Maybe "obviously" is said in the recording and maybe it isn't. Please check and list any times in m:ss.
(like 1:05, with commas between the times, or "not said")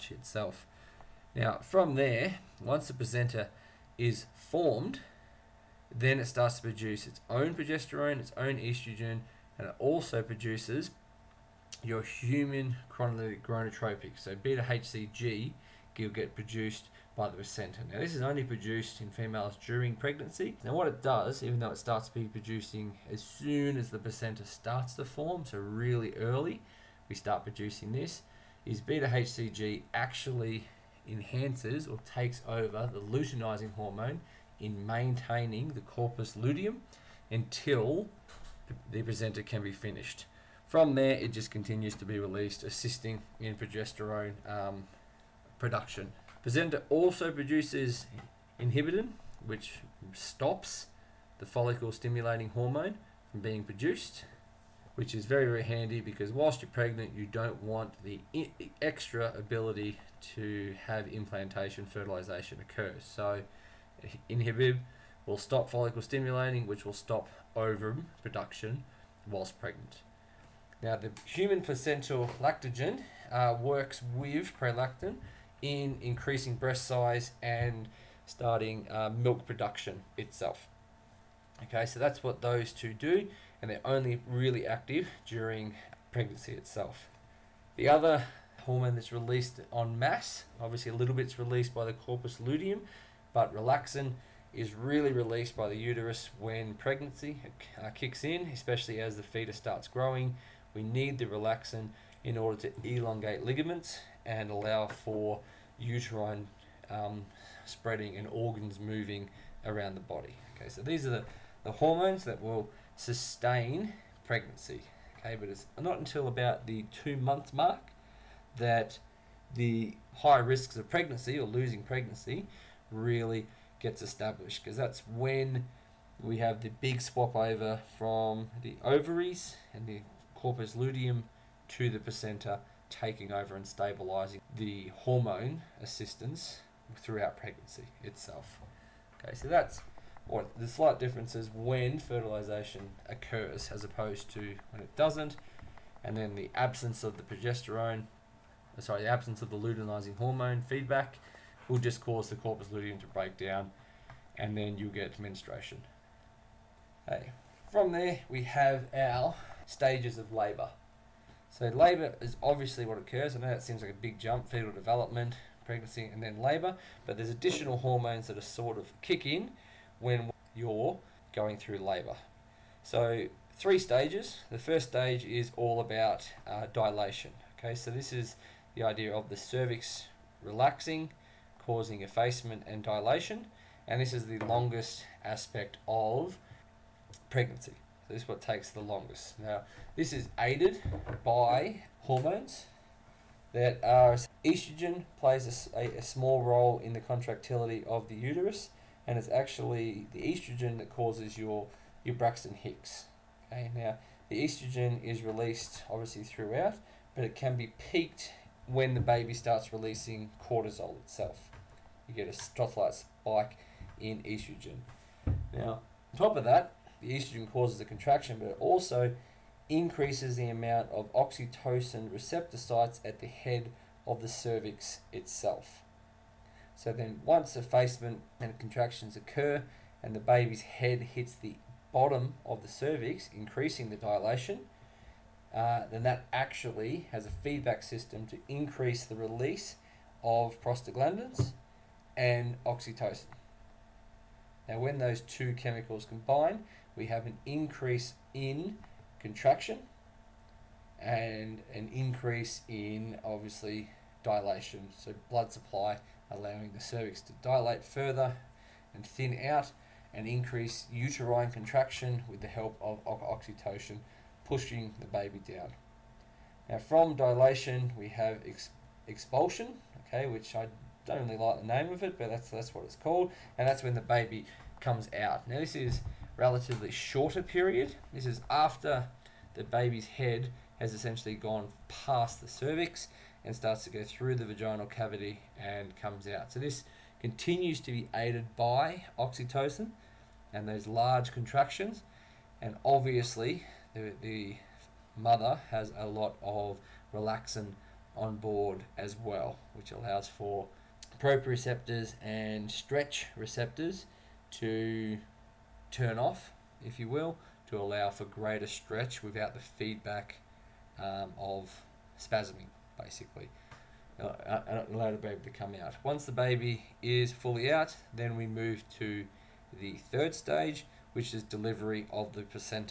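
1:30, 2:42, 3:25, 4:13, 4:52.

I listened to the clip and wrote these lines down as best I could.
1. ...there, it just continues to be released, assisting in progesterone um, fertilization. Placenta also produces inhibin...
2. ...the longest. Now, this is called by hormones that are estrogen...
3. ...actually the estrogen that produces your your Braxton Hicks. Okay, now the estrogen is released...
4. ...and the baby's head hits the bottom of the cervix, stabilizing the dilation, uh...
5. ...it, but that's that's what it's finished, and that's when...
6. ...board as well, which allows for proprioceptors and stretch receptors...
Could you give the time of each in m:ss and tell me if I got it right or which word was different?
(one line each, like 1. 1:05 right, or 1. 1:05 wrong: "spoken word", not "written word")
1. 0:40 wrong: "production", not "fertilization"
2. 3:08 wrong: "aided", not "called"
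3. 3:19 wrong: "causes", not "produces"
4. 3:50 wrong: "increasing", not "stabilizing"
5. 4:32 wrong: "called", not "finished"
6. 4:58 right.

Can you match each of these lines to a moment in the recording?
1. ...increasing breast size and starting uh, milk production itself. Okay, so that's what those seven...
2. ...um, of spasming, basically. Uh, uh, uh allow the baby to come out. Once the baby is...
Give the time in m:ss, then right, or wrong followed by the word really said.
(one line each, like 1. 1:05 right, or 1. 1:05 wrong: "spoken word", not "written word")
1. 1:16 wrong: "two", not "seven"
2. 5:11 right.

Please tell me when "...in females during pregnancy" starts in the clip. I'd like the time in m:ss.
0:19.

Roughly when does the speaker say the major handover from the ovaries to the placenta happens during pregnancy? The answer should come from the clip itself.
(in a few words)
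About 2 months.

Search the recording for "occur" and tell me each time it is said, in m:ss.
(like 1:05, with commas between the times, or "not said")
1:02, 2:23, 2:42, 3:49.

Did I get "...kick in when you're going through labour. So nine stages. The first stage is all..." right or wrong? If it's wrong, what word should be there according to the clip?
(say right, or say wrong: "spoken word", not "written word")
wrong: "three", not "nine".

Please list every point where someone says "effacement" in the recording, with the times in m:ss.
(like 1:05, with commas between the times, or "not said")
3:02, 3:47.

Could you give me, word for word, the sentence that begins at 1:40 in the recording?
We need the relaxin in order to elongate ligaments and allow for uterine um, spreading and organs moving around the body.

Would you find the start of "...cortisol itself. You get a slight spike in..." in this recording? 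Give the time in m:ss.
3:30.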